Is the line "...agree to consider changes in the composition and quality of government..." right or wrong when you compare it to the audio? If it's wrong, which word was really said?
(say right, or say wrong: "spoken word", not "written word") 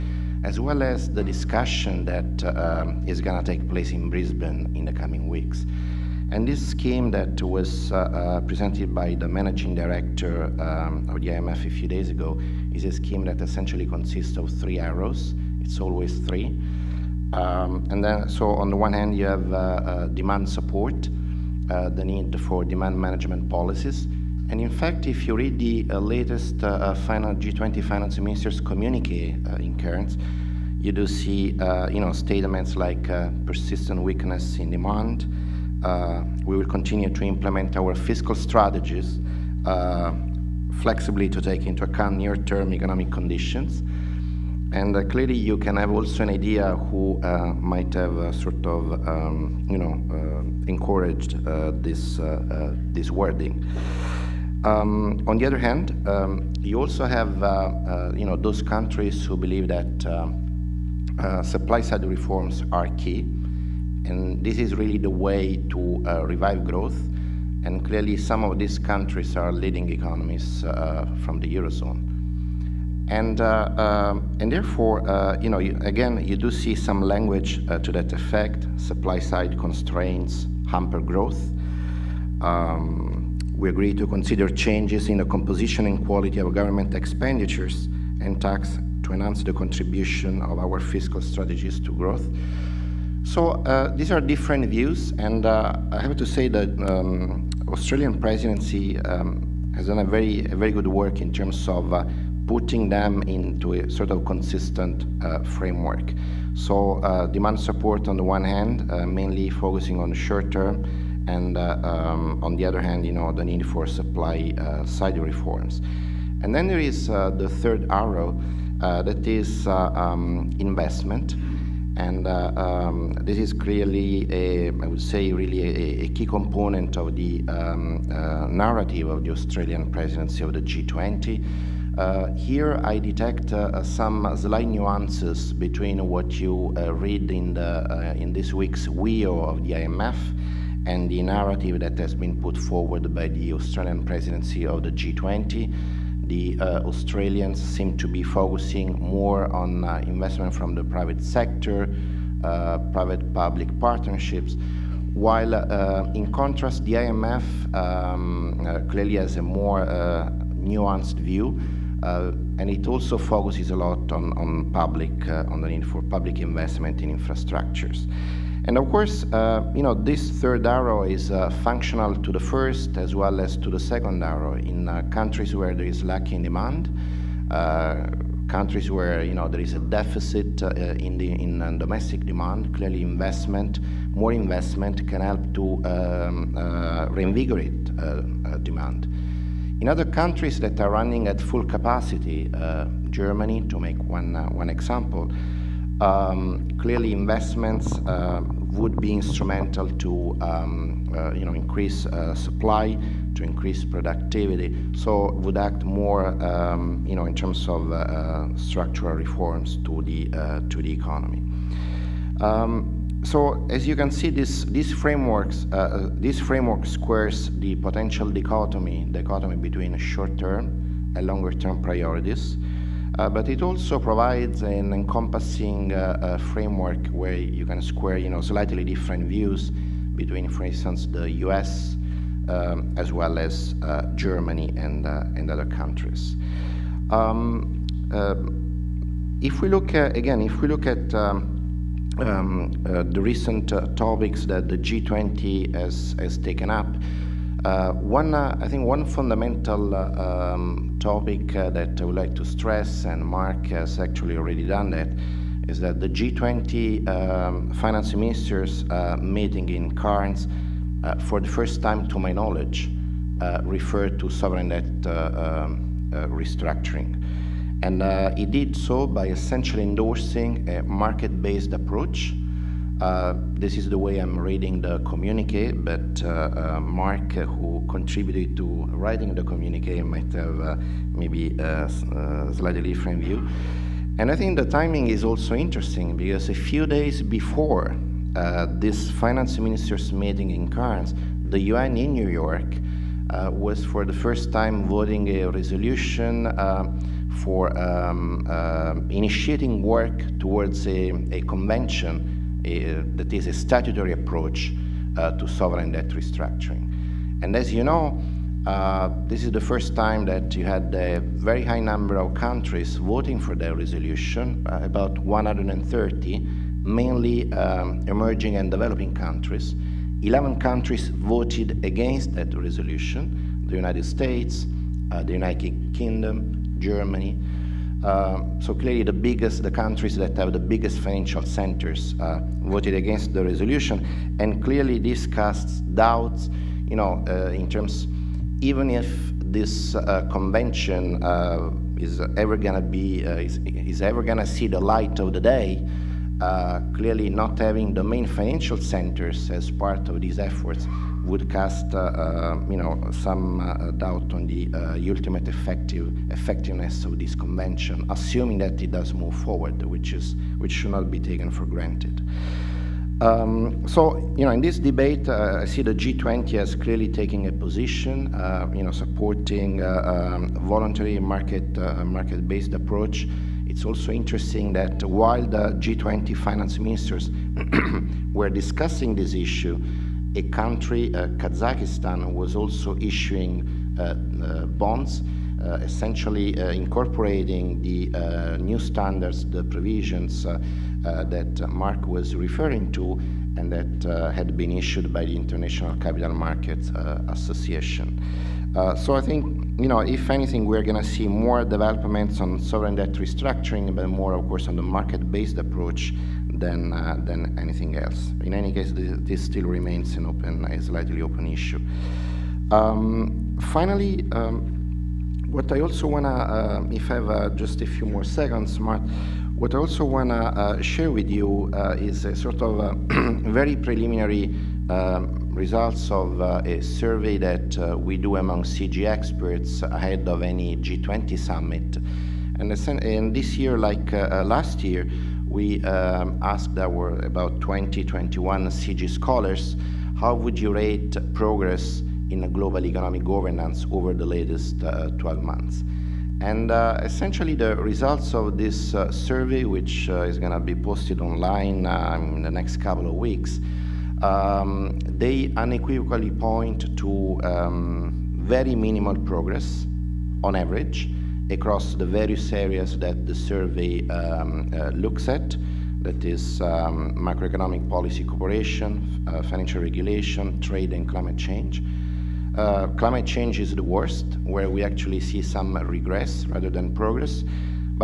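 right.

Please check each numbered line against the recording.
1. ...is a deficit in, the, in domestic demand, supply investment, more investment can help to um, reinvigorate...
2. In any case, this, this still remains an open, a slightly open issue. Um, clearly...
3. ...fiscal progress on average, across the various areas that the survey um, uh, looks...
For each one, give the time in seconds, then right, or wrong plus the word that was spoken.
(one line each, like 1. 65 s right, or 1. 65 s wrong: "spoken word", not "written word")
1. 179 s wrong: "clearly", not "supply"
2. 408 s wrong: "finally", not "clearly"
3. 458 s wrong: "minimal", not "fiscal".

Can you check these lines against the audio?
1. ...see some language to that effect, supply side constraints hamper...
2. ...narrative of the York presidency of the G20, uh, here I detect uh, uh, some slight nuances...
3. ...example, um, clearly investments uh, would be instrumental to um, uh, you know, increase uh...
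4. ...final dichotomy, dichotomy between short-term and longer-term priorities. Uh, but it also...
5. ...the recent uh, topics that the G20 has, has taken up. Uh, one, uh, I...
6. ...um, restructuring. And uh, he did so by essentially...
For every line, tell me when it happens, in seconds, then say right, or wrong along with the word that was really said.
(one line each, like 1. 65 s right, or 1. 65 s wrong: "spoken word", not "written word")
1. 76 s right
2. 128 s wrong: "Australian", not "York"
3. 194 s right
4. 217 s wrong: "potential", not "final"
5. 243 s right
6. 265 s right.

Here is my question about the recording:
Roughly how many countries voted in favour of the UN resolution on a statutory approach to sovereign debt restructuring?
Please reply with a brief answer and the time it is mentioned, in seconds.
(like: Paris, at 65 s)
130, at 314 s.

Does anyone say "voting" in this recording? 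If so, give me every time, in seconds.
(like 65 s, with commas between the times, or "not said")
294 s, 312 s.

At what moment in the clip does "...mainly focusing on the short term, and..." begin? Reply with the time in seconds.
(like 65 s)
109 s.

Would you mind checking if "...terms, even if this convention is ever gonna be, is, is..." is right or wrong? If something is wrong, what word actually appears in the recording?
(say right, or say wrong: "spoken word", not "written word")
right.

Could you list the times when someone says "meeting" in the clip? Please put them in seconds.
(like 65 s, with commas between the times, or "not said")
259 s, 290 s.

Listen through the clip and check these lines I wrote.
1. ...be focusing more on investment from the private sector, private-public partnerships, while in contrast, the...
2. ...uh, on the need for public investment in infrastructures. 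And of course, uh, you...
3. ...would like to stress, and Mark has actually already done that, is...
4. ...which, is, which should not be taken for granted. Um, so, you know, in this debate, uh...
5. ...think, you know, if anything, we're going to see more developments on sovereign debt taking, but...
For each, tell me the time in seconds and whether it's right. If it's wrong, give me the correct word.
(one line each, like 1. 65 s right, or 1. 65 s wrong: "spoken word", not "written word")
1. 148 s right
2. 165 s right
3. 252 s right
4. 359 s right
5. 399 s wrong: "restructuring", not "taking".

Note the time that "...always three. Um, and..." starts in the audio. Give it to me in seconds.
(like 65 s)
15 s.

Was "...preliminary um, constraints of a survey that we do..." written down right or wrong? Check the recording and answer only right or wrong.
wrong.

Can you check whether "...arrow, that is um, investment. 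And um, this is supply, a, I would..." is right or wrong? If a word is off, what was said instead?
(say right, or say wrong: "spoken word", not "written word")
wrong: "clearly", not "supply".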